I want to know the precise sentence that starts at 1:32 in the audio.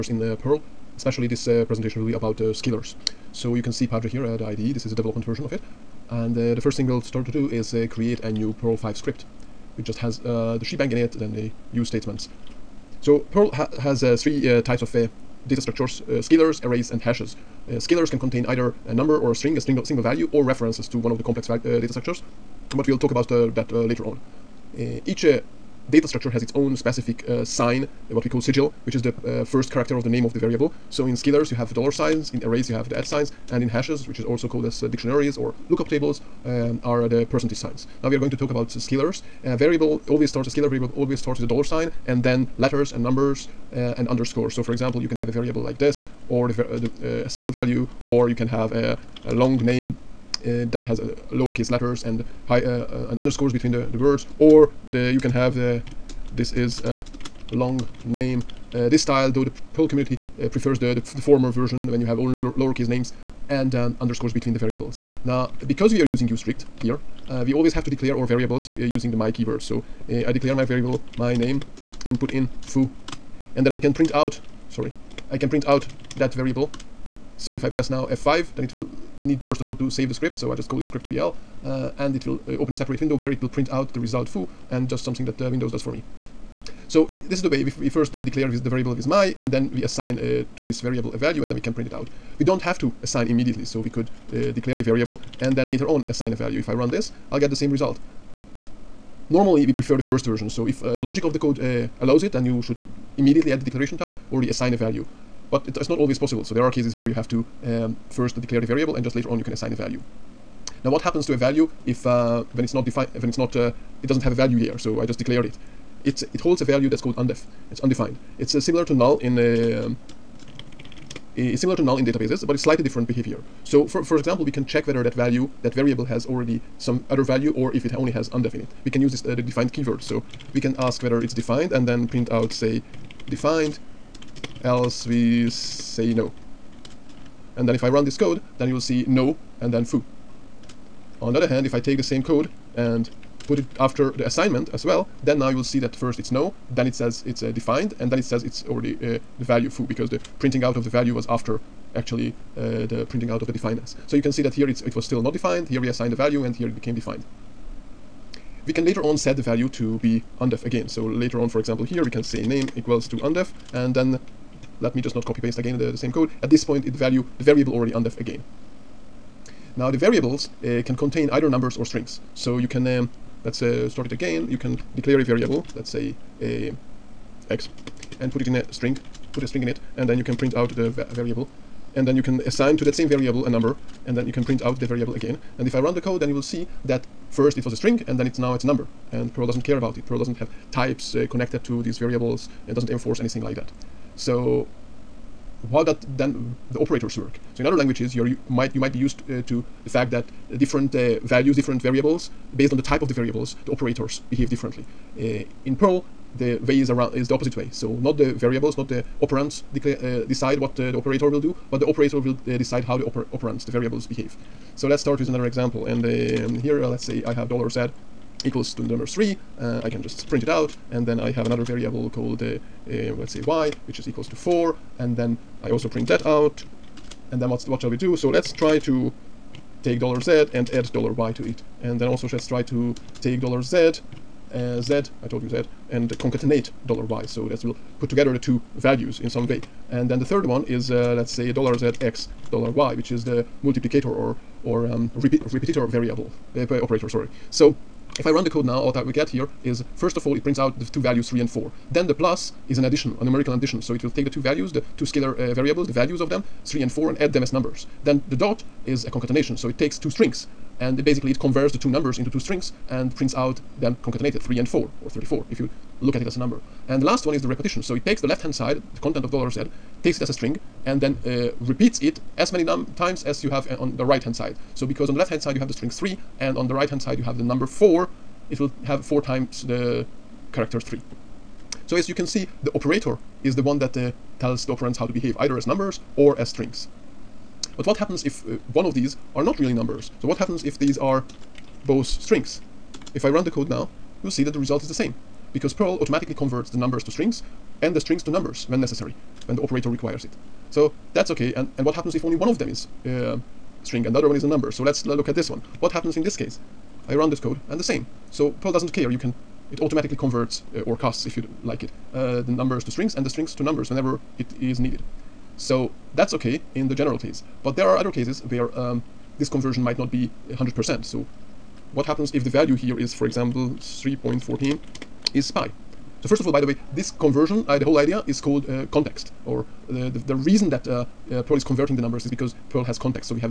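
We don't have to assign immediately so we could uh, declare the variable and then later on assign a value.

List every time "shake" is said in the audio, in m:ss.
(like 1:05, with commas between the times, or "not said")
not said.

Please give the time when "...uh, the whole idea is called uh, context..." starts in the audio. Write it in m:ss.
5:27.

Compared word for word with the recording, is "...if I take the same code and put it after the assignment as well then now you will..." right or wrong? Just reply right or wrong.
right.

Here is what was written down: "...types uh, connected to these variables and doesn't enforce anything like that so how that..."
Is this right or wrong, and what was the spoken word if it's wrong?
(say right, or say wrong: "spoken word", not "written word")
right.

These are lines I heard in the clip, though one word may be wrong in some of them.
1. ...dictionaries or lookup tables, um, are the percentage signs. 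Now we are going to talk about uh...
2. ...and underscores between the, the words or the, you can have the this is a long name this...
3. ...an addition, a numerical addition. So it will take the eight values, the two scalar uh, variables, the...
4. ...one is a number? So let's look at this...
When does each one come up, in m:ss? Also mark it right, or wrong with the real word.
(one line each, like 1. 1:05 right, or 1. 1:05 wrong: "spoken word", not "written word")
1. 0:34 right
2. 0:52 right
3. 4:12 wrong: "two", not "eight"
4. 5:04 right.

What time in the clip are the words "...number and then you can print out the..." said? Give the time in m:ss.
3:03.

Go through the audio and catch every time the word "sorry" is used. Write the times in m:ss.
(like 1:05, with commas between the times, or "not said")
1:14, 4:07.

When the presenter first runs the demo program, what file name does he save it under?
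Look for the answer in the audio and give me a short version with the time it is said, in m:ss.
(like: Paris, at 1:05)
script PL, at 1:20.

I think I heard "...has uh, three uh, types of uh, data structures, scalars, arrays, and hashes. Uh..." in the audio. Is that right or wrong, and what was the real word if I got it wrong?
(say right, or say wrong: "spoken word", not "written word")
right.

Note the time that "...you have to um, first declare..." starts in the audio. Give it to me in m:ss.
1:47.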